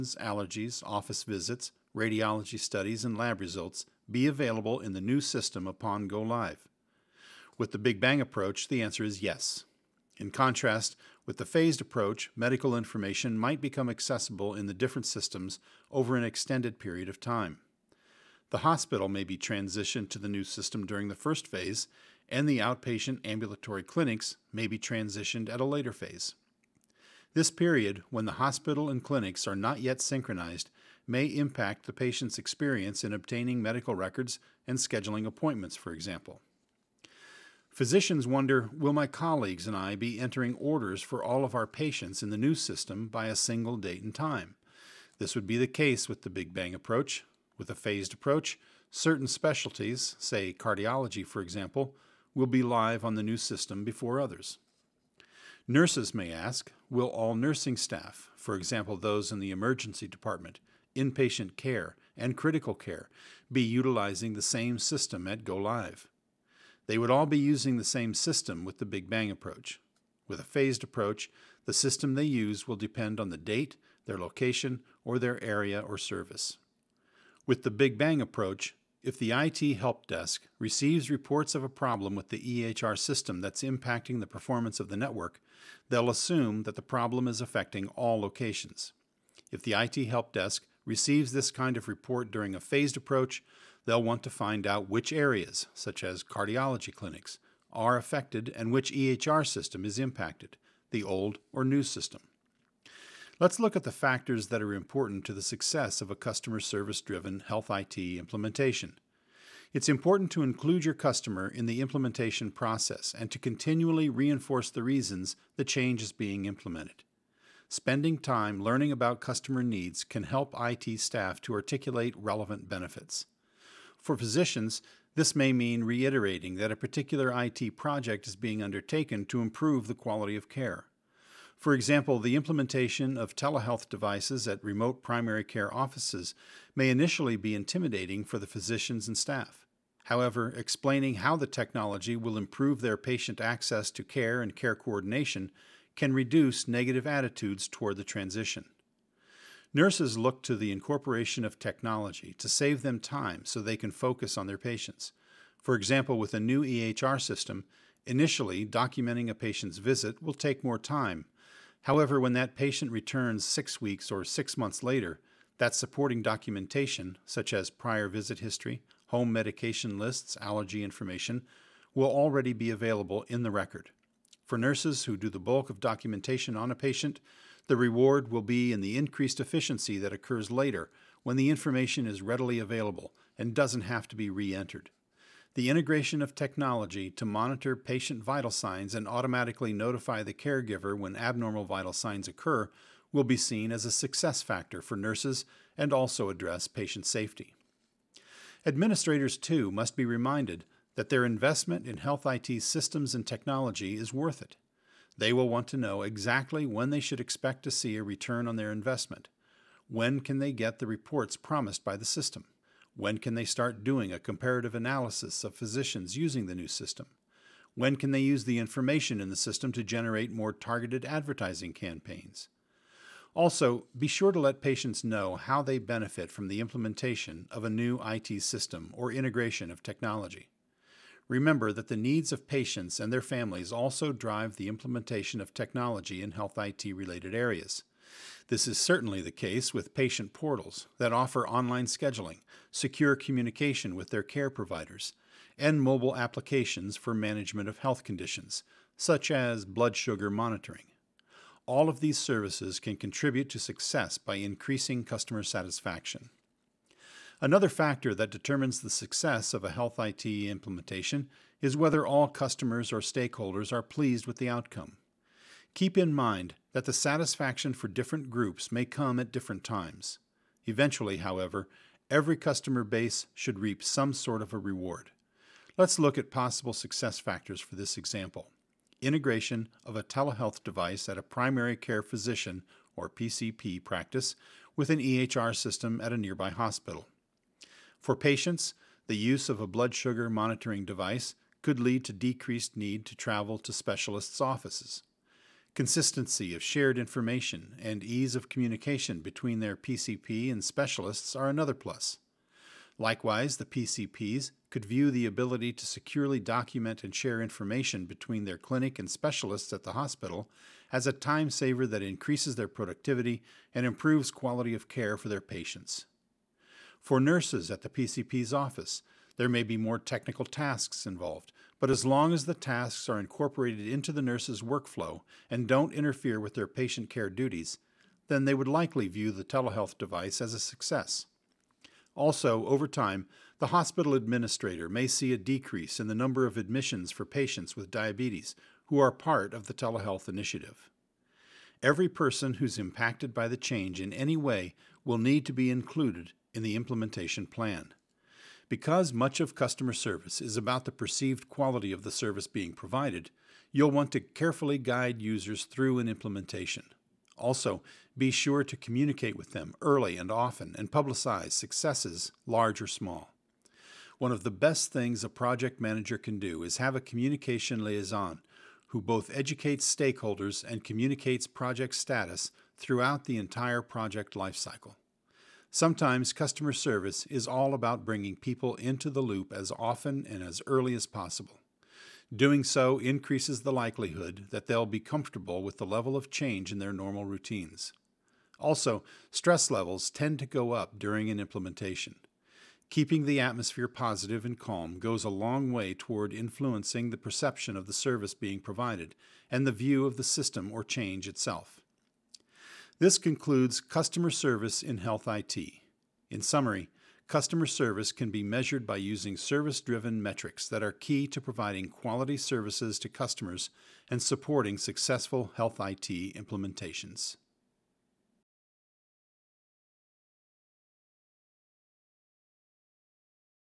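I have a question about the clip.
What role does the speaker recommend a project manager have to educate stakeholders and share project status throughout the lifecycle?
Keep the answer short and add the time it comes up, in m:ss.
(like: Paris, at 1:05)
communication liaison, at 6:07.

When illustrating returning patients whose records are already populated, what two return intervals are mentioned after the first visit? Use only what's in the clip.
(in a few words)
six weeks or six months.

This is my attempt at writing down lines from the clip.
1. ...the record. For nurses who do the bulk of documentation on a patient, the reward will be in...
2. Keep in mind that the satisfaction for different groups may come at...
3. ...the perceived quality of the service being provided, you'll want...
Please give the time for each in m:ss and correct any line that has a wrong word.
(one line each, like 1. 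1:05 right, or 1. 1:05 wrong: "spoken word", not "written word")
1. 2:53 right
2. 4:25 right
3. 5:50 right.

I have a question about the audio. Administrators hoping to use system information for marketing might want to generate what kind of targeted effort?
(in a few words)
advertising campaigns.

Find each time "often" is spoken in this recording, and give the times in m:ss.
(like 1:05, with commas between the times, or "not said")
6:00, 6:19.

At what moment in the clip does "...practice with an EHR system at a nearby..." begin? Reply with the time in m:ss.
4:43.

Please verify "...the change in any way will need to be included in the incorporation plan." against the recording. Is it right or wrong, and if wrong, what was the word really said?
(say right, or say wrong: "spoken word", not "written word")
wrong: "implementation", not "incorporation".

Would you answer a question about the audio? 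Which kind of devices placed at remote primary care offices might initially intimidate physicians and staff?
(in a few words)
telehealth devices.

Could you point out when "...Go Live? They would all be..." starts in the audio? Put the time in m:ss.
1:05.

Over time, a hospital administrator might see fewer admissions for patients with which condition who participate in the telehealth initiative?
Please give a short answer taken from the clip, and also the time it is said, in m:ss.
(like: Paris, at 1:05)
diabetes, at 5:37.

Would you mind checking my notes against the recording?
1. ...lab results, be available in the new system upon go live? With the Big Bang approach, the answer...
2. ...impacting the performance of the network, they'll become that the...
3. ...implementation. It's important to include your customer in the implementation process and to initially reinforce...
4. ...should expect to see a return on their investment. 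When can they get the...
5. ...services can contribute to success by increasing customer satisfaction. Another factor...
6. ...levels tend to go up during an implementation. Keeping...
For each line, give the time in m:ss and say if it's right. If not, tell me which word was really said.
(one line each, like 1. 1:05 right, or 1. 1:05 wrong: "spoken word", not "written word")
1. 0:03 right
2. 1:23 wrong: "assume", not "become"
3. 1:47 wrong: "continually", not "initially"
4. 3:27 right
5. 4:12 right
6. 6:29 right.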